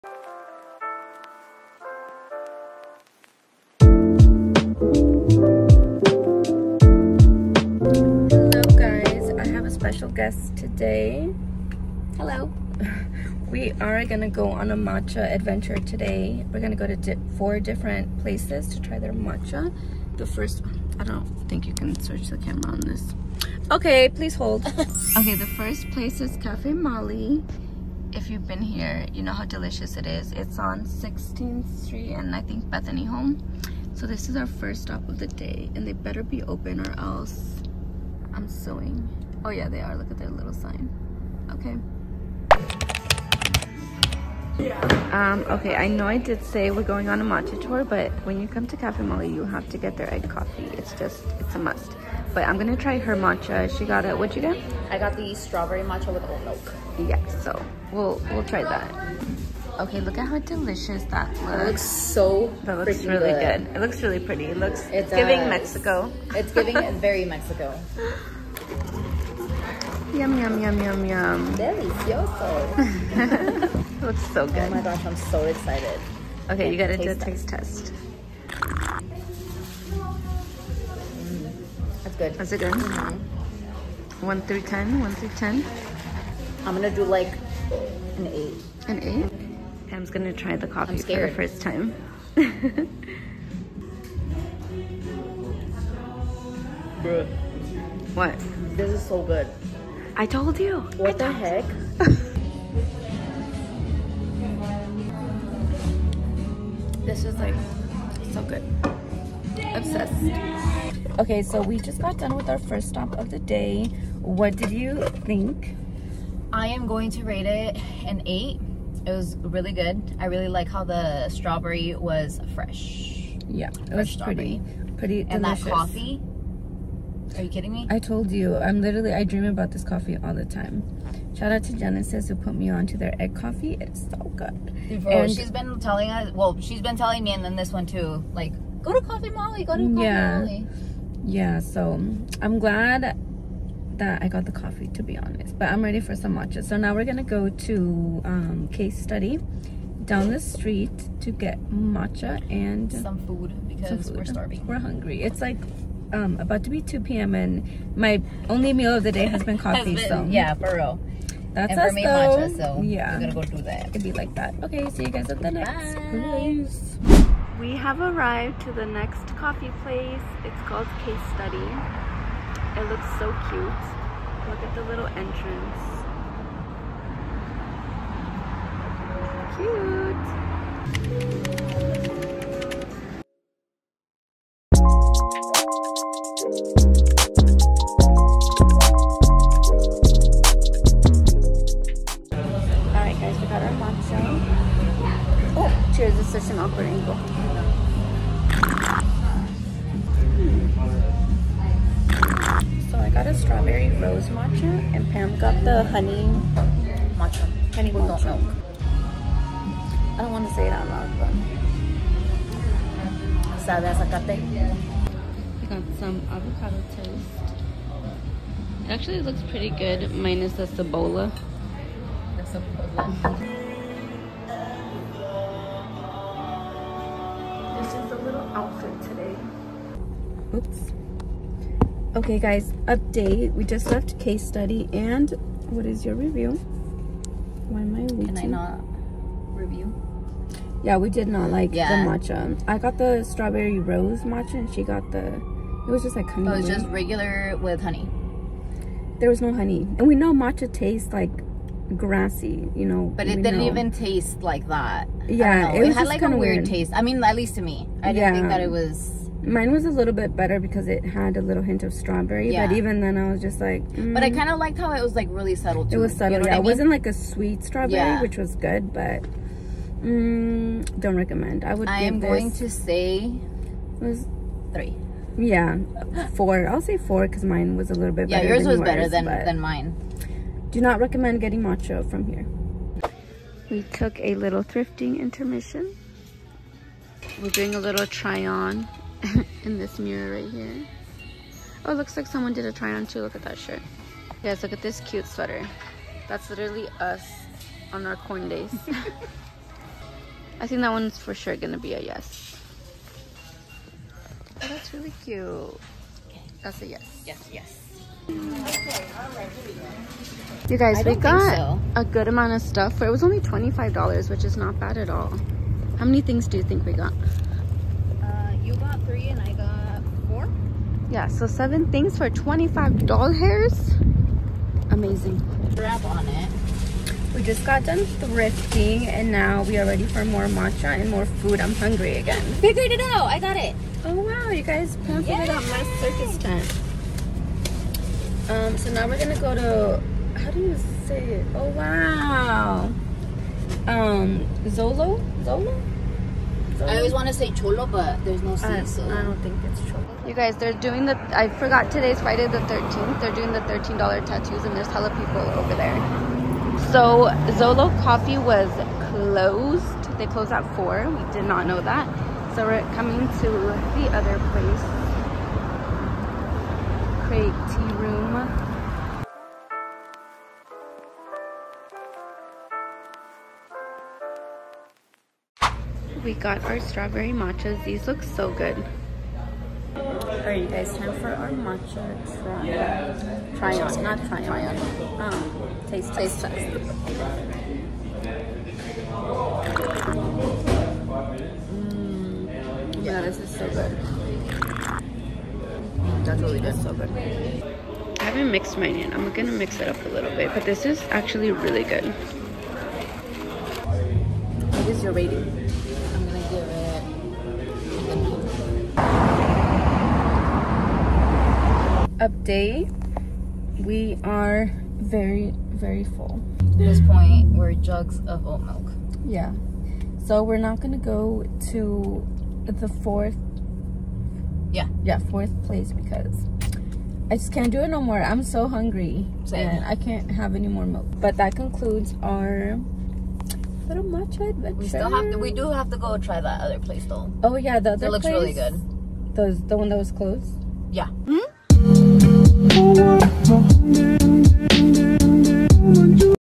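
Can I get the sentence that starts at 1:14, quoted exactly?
Oh my gosh, I'm so excited.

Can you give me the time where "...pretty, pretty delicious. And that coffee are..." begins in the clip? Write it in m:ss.
2:04.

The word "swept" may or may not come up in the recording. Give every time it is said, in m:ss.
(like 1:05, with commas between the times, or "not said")
not said.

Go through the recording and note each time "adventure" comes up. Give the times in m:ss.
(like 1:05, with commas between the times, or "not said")
0:15, 7:14.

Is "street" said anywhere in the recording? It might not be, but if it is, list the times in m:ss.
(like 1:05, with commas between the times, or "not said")
0:31, 2:30.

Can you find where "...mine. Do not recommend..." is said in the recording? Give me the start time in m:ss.
4:39.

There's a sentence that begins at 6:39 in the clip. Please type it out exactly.
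I'm gonna mix it up a little bit, but this is actually really good.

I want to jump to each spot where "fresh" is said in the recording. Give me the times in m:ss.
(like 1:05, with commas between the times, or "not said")
2:02.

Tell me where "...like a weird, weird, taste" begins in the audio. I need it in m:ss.
4:16.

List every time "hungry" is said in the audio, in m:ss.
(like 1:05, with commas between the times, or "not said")
2:34, 5:31, 7:08.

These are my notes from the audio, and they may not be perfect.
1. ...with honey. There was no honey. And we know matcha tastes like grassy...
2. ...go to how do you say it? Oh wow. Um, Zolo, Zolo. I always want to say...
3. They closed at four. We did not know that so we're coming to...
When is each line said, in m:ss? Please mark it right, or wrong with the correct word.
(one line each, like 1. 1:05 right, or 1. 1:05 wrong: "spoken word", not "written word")
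1. 4:07 right
2. 5:39 right
3. 6:00 right.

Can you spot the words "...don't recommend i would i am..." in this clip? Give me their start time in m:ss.
4:30.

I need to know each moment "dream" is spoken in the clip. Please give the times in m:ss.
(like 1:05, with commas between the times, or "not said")
2:09.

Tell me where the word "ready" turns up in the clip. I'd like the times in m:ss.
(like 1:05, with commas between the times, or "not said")
2:25, 5:29.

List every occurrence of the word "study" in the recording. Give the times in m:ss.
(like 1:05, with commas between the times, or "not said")
2:29, 2:51, 3:54.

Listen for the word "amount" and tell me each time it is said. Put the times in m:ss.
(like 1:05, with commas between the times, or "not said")
5:12.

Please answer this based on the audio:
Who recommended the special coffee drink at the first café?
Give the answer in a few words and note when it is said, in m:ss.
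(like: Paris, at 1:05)
Genesis, at 2:11.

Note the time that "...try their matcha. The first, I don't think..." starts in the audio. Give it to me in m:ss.
0:18.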